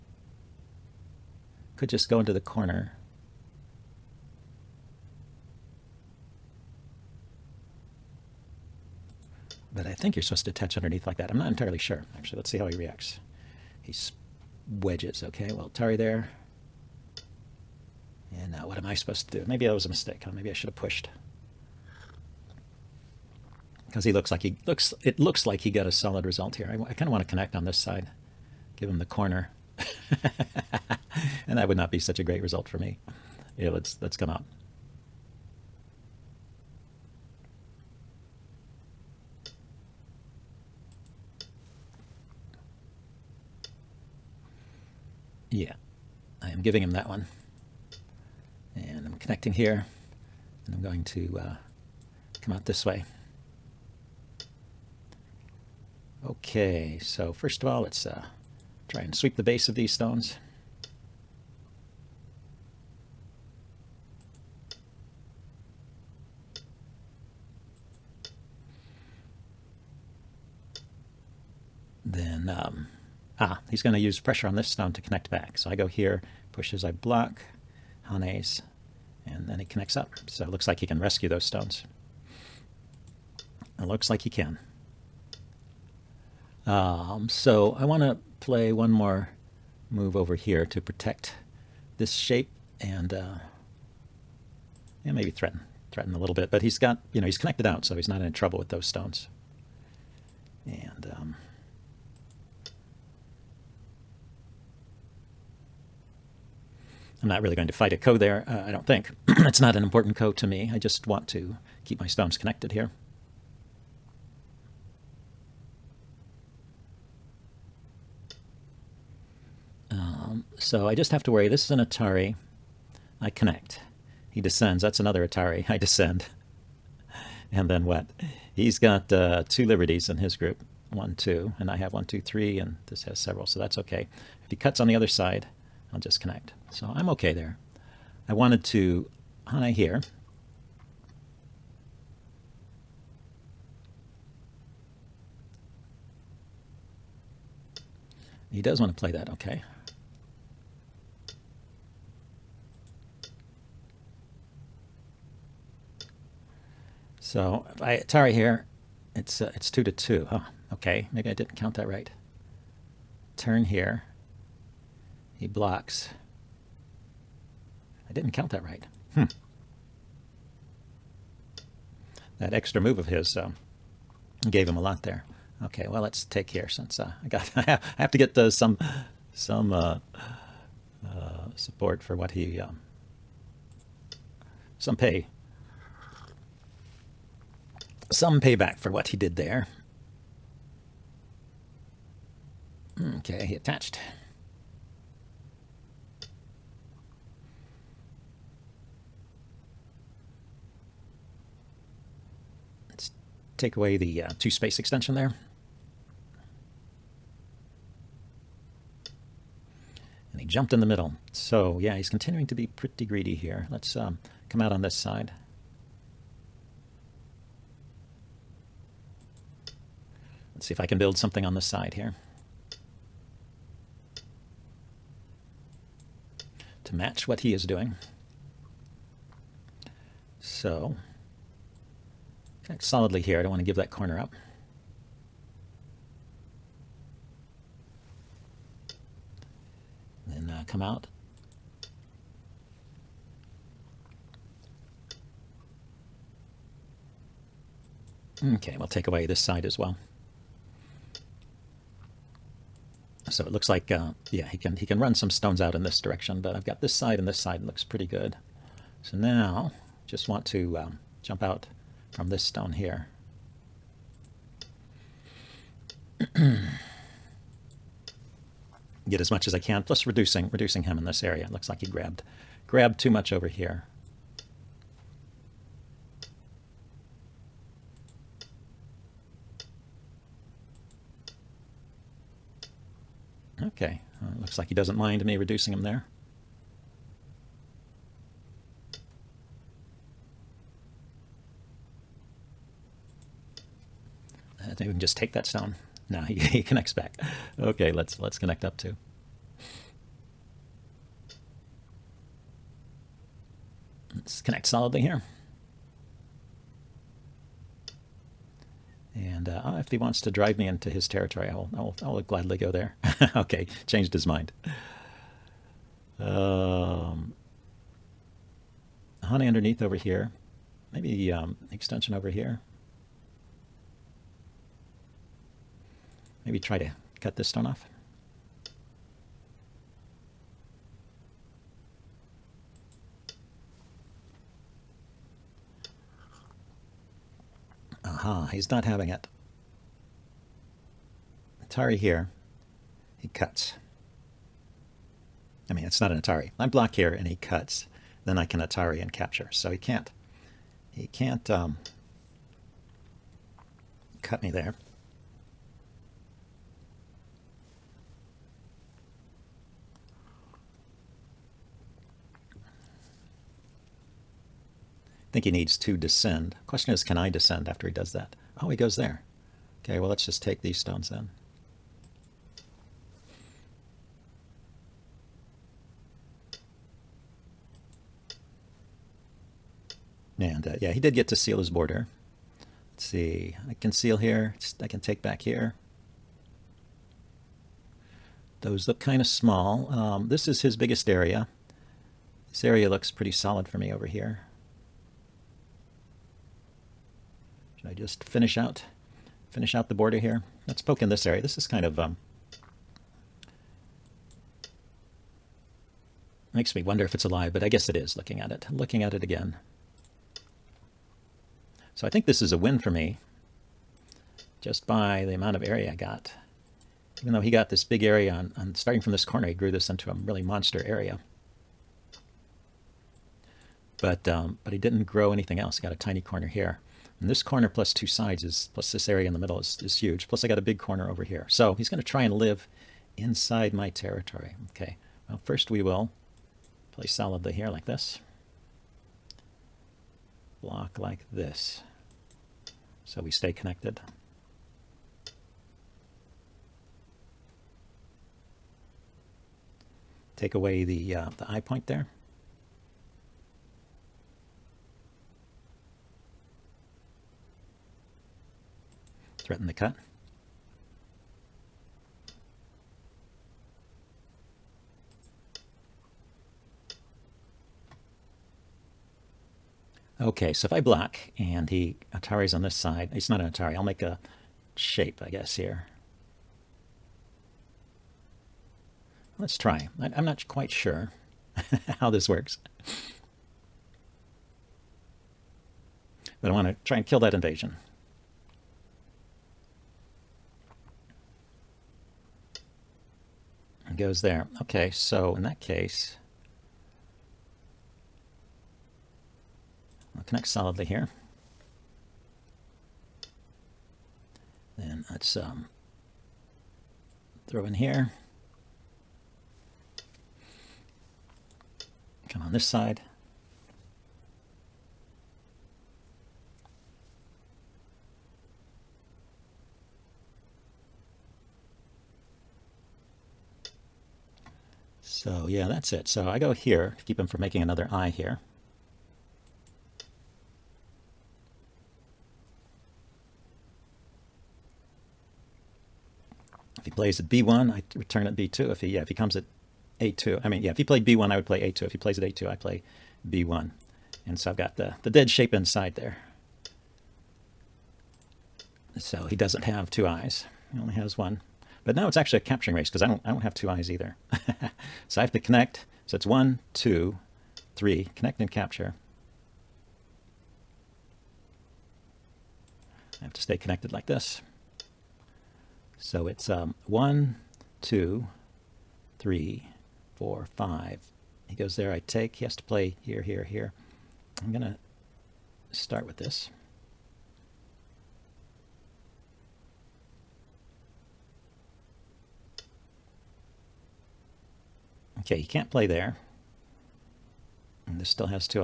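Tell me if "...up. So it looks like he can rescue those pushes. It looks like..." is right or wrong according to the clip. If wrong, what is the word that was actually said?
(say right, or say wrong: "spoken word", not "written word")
wrong: "stones", not "pushes".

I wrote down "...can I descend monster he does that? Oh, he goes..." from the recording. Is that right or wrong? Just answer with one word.
wrong.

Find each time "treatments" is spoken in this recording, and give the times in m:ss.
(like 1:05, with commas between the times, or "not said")
not said.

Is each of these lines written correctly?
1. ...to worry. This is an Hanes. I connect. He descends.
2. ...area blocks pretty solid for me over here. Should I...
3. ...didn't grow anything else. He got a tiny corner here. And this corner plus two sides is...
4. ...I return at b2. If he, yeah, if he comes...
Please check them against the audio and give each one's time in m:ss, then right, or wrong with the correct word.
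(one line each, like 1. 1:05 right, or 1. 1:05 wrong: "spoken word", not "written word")
1. 2:01 wrong: "Atari", not "Hanes"
2. 6:32 wrong: "looks", not "blocks"
3. 7:04 right
4. 8:57 right.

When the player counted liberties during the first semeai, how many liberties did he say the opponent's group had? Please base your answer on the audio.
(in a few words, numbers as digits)
2.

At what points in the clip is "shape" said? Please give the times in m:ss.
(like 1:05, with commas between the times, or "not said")
1:32, 7:54, 9:05.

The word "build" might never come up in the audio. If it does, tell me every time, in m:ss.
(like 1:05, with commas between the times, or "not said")
3:40.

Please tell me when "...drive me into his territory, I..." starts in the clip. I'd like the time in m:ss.
5:10.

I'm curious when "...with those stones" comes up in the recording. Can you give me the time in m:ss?
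1:38.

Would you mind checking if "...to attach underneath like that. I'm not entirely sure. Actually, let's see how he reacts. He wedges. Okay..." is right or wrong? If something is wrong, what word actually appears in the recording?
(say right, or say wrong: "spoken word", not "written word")
right.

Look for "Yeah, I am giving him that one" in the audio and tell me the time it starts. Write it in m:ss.
0:45.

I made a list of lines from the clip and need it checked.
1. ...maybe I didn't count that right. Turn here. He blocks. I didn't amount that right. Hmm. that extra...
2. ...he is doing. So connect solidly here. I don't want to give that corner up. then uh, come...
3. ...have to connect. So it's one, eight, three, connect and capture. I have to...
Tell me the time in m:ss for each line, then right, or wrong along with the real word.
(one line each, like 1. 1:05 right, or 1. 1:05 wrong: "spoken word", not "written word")
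1. 2:41 wrong: "count", not "amount"
2. 3:47 right
3. 9:15 wrong: "two", not "eight".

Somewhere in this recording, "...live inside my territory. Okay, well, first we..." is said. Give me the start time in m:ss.
7:12.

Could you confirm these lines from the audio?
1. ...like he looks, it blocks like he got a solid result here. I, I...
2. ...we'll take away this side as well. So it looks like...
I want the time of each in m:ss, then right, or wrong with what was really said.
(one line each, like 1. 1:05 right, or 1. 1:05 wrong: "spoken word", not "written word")
1. 0:24 wrong: "looks", not "blocks"
2. 4:08 right.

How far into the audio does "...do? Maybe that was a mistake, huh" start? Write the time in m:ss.
0:19.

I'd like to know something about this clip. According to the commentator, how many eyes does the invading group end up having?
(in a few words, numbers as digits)
1.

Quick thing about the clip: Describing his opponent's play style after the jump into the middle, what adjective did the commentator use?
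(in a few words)
Greedy.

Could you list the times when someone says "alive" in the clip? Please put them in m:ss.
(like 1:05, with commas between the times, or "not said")
6:47.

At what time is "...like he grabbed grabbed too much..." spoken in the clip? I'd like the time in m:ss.
4:31.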